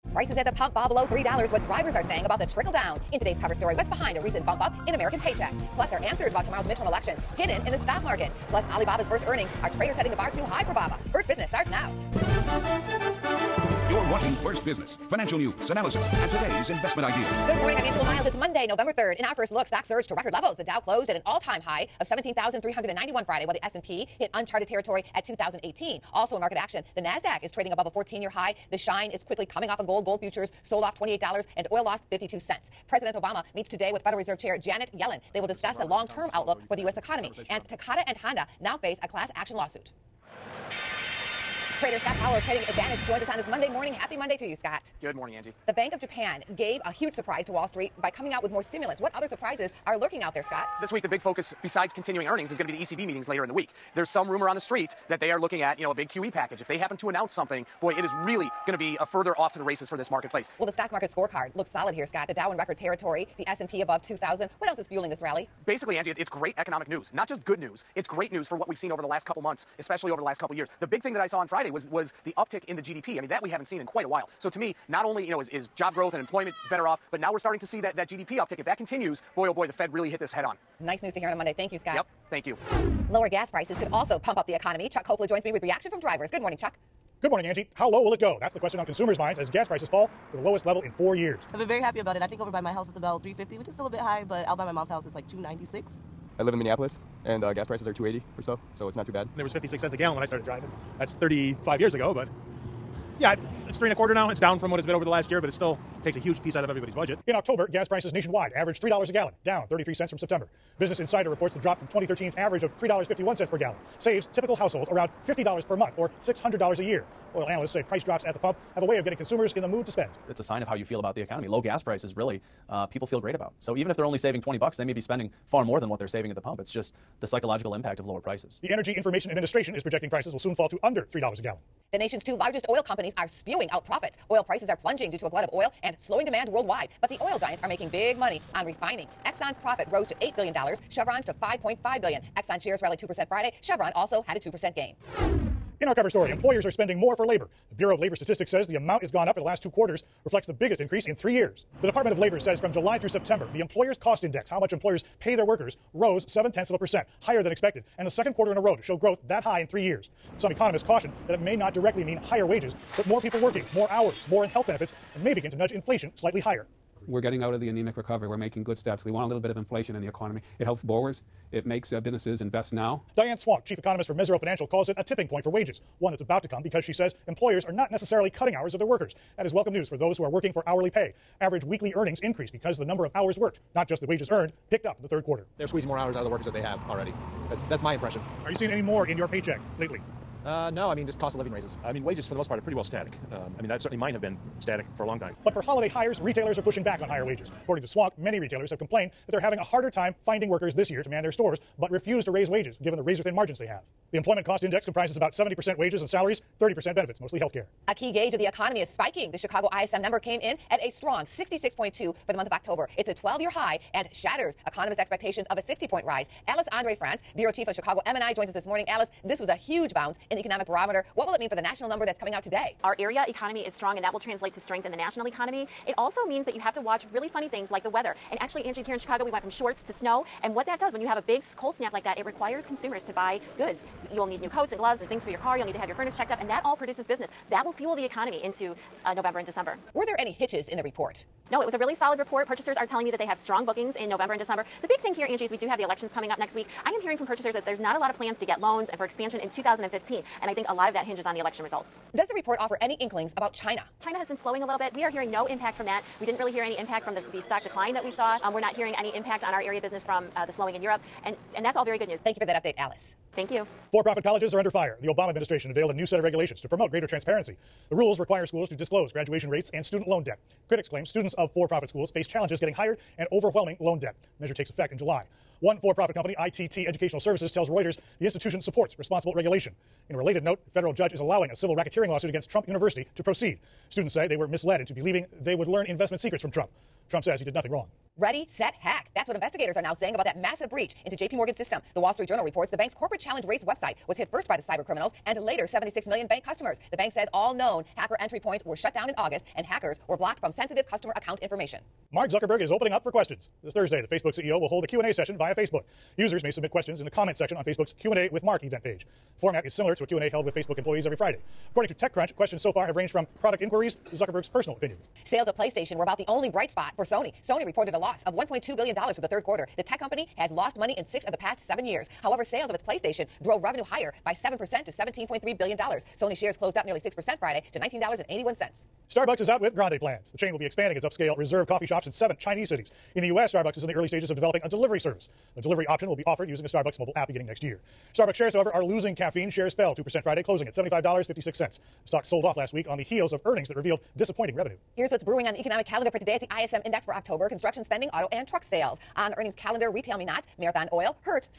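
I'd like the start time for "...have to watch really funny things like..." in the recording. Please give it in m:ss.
3:46.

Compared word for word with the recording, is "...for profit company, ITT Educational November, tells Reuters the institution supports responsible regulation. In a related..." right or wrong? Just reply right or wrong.
wrong.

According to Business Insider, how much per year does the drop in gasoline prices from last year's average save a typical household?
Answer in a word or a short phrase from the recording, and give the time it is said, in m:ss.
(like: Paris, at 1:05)
$600, at 1:56.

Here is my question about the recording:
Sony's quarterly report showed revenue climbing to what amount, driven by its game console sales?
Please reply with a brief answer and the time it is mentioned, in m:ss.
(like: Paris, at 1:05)
$17.3 billion, at 5:24.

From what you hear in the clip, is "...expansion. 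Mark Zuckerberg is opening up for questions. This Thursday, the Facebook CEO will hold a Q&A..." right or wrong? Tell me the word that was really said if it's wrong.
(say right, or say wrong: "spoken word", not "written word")
wrong: "information", not "expansion".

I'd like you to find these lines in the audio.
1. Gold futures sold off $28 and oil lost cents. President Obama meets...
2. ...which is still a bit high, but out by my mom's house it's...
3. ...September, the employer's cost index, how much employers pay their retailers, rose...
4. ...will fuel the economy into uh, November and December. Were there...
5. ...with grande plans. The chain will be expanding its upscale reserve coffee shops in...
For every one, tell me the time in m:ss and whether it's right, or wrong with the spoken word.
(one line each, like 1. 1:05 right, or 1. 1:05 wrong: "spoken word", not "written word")
1. 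0:30 right
2. 1:33 right
3. 2:33 wrong: "workers", not "retailers"
4. 3:57 right
5. 5:29 right.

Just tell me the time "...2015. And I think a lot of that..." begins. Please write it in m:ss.
4:09.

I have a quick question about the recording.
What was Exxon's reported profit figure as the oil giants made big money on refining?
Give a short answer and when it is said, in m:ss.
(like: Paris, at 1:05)
$8 billion, at 2:20.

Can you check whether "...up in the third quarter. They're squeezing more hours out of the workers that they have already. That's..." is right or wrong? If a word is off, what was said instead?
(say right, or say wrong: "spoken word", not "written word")
right.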